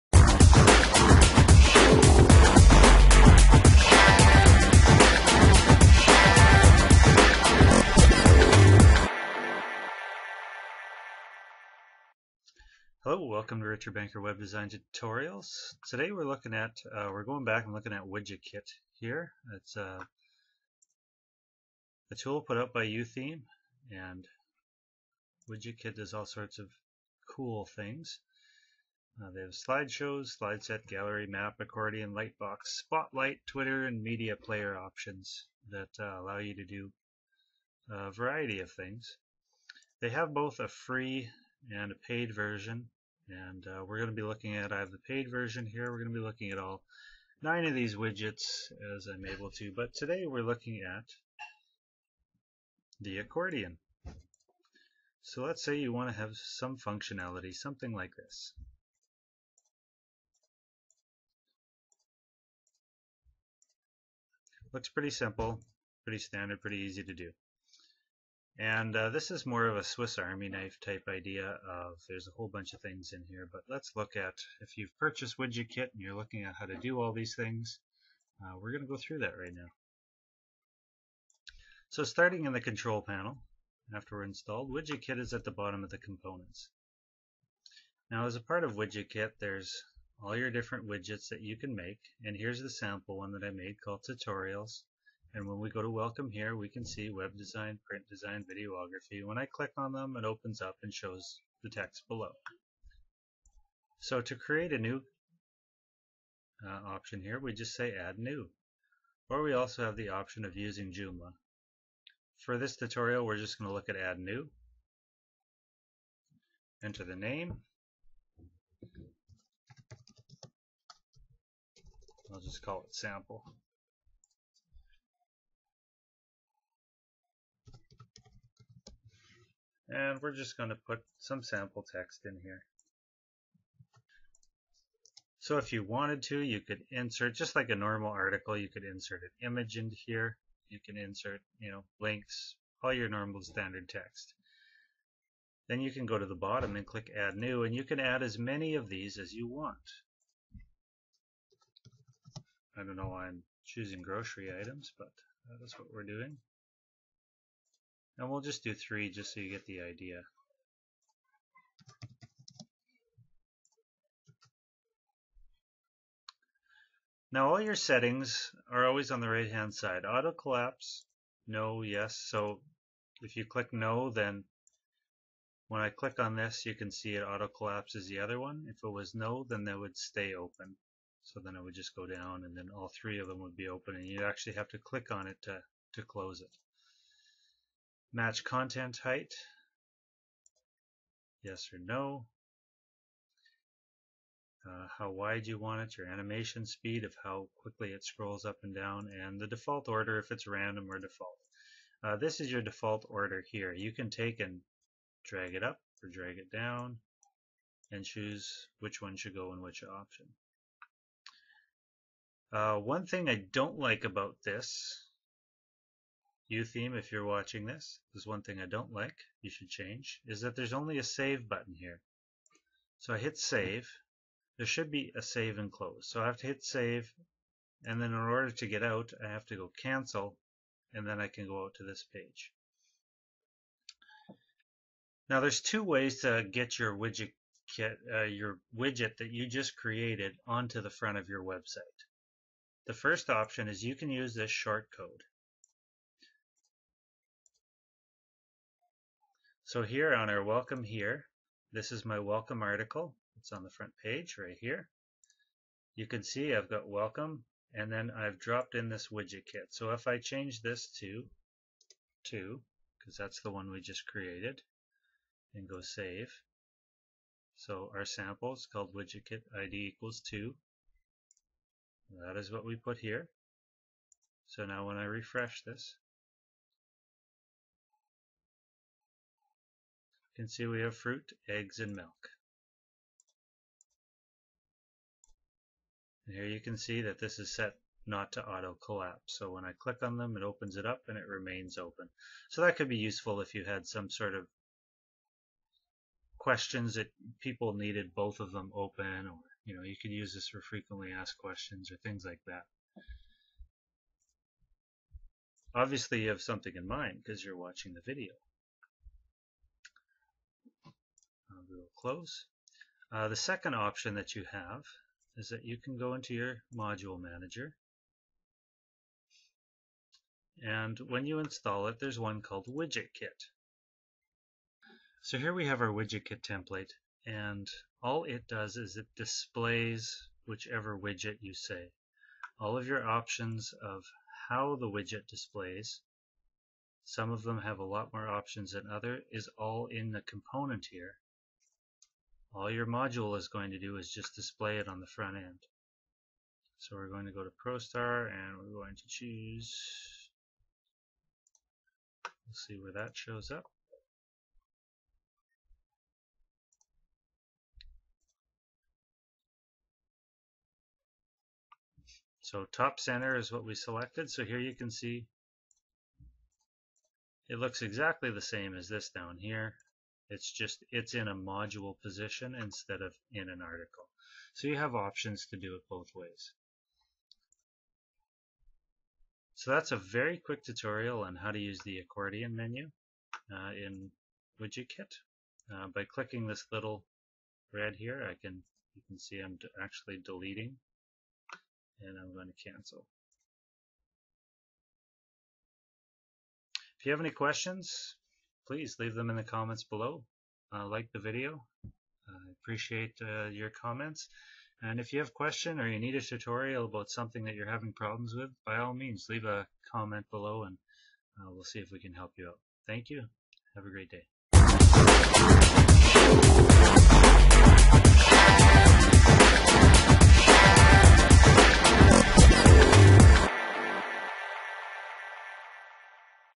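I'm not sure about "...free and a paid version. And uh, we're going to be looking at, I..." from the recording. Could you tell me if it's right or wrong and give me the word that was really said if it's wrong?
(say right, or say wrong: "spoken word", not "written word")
right.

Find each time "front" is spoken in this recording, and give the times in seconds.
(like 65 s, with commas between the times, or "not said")
240 s, 253 s, 345 s.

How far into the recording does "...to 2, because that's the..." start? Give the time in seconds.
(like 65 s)
260 s.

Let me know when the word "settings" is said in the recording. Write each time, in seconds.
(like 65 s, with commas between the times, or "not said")
167 s.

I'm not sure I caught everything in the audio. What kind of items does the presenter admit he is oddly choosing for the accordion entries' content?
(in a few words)
grocery items.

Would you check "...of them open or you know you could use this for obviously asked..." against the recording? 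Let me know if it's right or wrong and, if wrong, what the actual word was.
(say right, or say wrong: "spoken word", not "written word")
wrong: "frequently", not "obviously".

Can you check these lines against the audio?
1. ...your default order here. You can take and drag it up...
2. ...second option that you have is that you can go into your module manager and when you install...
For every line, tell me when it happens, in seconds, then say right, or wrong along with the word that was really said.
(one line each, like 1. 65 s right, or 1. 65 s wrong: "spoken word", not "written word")
1. 202 s right
2. 313 s right.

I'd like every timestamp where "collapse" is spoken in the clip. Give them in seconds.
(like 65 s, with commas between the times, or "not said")
170 s, 177 s, 288 s.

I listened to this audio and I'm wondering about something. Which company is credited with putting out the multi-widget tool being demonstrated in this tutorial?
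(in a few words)
YooTheme.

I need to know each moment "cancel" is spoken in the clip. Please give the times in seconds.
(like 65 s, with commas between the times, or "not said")
229 s, 392 s.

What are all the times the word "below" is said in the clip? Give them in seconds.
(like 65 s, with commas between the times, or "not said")
102 s, 399 s, 410 s.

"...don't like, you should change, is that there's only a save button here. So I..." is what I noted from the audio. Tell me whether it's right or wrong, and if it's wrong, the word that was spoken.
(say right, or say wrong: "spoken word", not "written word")
right.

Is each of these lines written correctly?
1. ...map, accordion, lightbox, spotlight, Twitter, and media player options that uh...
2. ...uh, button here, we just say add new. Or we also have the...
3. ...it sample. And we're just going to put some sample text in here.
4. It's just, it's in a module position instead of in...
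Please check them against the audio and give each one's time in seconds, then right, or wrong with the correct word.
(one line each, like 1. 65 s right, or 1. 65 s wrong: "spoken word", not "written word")
1. 31 s right
2. 106 s wrong: "option", not "button"
3. 122 s right
4. 370 s right.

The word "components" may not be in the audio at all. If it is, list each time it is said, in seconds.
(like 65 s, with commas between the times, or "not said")
85 s, 340 s.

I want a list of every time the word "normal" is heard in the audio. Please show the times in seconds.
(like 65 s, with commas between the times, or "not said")
137 s, 143 s.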